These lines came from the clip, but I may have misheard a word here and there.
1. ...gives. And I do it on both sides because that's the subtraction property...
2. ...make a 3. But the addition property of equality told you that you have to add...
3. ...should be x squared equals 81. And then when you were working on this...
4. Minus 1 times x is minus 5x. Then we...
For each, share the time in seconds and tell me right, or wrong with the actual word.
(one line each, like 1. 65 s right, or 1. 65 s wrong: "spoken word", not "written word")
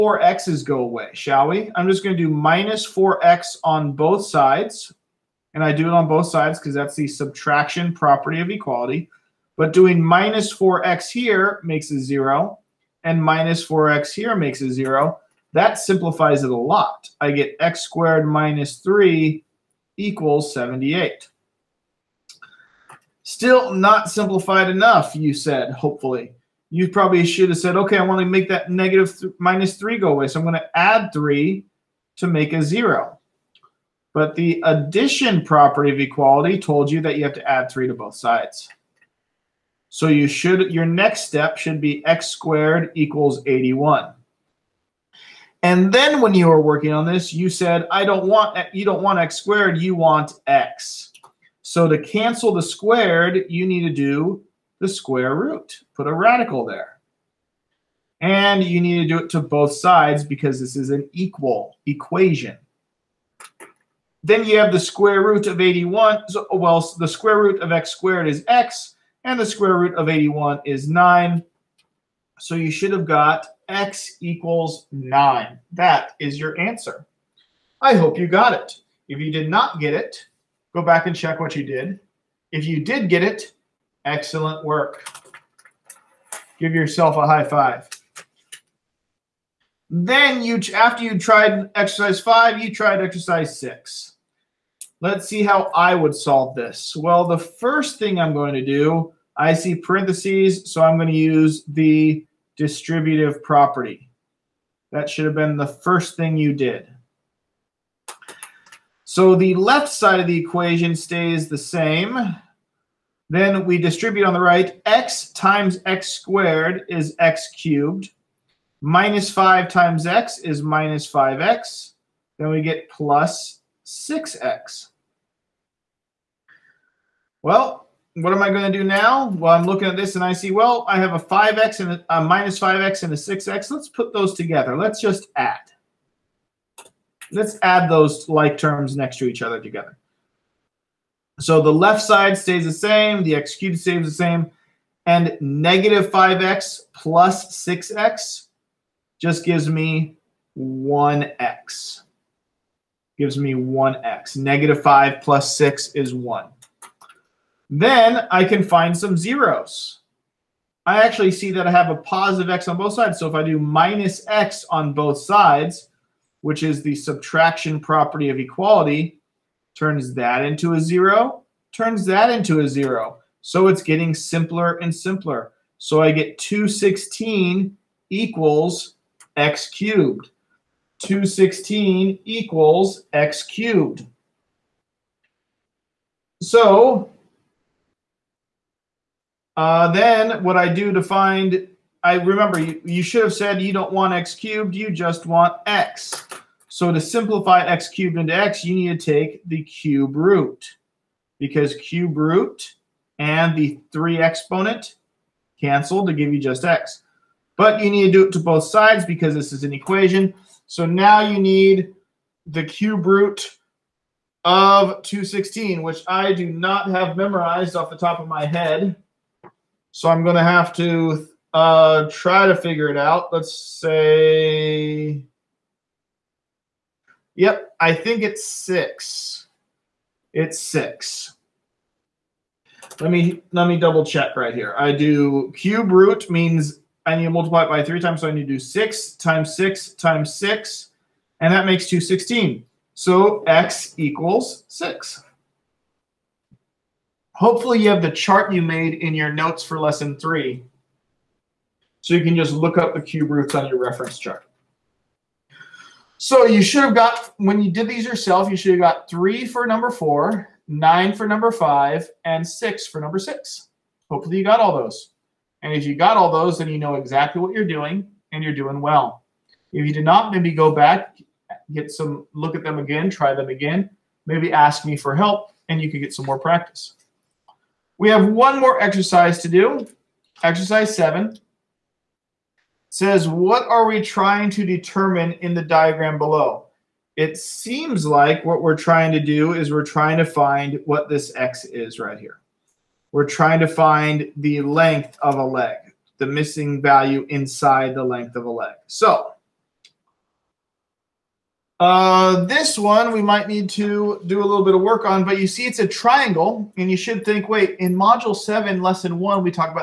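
1. 4 s wrong: "sides", not "gives"
2. 32 s wrong: "0", not "3"
3. 41 s right
4. 118 s wrong: "5", not "1".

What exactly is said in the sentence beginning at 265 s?
And if you got all those, then you know exactly what you're doing and you're doing well.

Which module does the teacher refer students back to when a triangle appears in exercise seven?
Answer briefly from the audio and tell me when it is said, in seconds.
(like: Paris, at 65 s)
Module 7, at 307 s.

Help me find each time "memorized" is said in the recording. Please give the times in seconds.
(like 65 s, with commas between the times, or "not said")
217 s.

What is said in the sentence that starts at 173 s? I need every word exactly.
So it's getting simpler and simpler.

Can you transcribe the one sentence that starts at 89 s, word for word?
Then you, after you tried exercise five, you tried exercise six.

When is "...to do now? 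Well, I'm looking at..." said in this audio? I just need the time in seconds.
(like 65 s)
128 s.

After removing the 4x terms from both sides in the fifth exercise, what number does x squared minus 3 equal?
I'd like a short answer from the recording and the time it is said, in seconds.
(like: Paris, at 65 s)
78, at 20 s.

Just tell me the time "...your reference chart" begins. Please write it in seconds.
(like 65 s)
253 s.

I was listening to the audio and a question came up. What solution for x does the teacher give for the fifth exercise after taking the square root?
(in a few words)
9.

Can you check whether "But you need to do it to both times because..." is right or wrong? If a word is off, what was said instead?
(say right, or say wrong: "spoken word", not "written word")
wrong: "sides", not "times".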